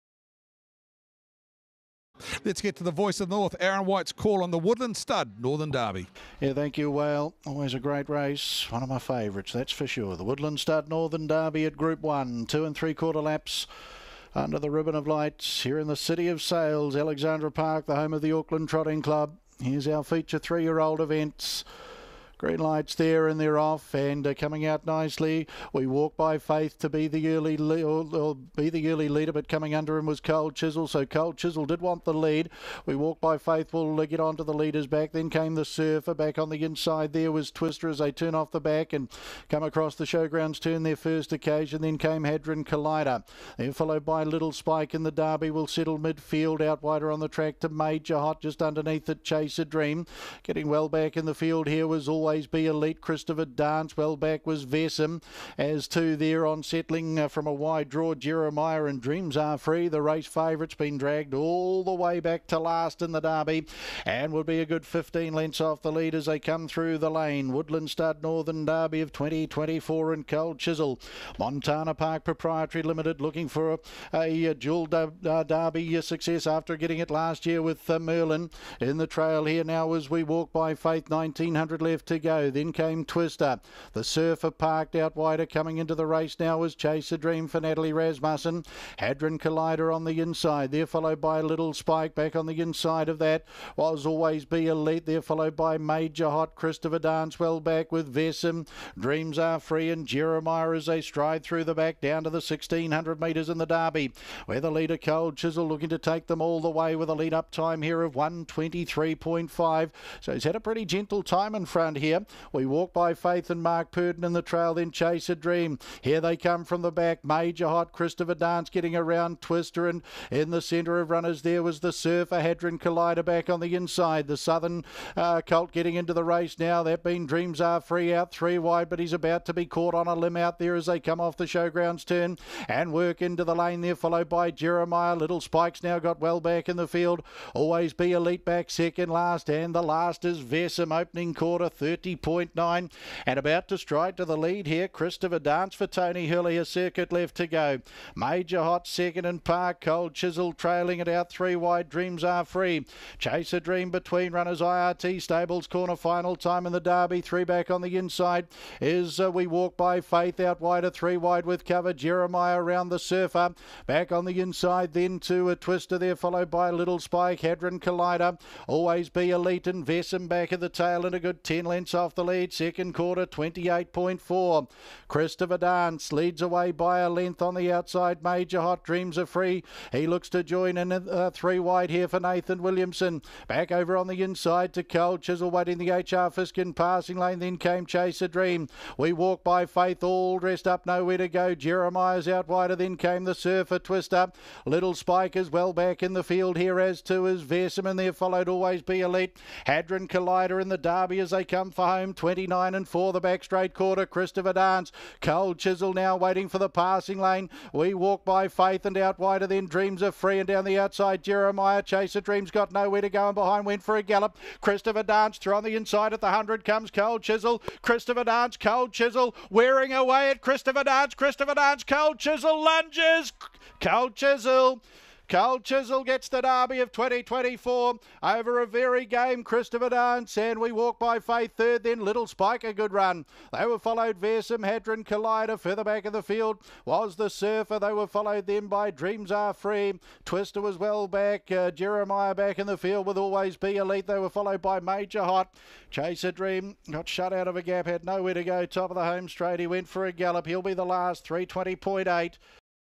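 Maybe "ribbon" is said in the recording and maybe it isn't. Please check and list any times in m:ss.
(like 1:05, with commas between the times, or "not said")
0:14.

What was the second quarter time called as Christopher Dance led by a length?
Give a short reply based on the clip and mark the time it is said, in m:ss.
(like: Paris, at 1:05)
28.4, at 2:53.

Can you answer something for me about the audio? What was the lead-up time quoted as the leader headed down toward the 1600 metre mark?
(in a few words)
123.5.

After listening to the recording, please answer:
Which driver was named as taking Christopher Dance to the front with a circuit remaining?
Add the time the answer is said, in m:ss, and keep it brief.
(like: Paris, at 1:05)
Tony Herlihy, at 2:25.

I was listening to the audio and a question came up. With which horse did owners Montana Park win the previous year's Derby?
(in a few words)
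Merlin.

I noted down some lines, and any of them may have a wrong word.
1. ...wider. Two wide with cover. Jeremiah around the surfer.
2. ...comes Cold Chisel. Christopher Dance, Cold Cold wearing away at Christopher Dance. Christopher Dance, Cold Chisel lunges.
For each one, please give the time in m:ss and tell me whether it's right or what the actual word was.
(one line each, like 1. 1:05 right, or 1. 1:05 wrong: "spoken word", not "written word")
1. 2:40 wrong: "Three", not "Two"
2. 3:36 wrong: "Chisel", not "Cold".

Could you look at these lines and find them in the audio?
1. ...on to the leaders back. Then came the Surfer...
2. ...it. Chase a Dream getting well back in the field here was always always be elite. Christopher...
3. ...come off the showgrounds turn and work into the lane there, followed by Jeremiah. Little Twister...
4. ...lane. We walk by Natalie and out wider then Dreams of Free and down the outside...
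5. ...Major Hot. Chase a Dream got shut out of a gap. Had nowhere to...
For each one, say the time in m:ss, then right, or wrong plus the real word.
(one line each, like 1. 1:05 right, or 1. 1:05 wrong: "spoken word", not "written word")
1. 0:34 right
2. 0:49 right
3. 2:10 wrong: "Spikes", not "Twister"
4. 3:27 wrong: "Faith", not "Natalie"
5. 4:04 right.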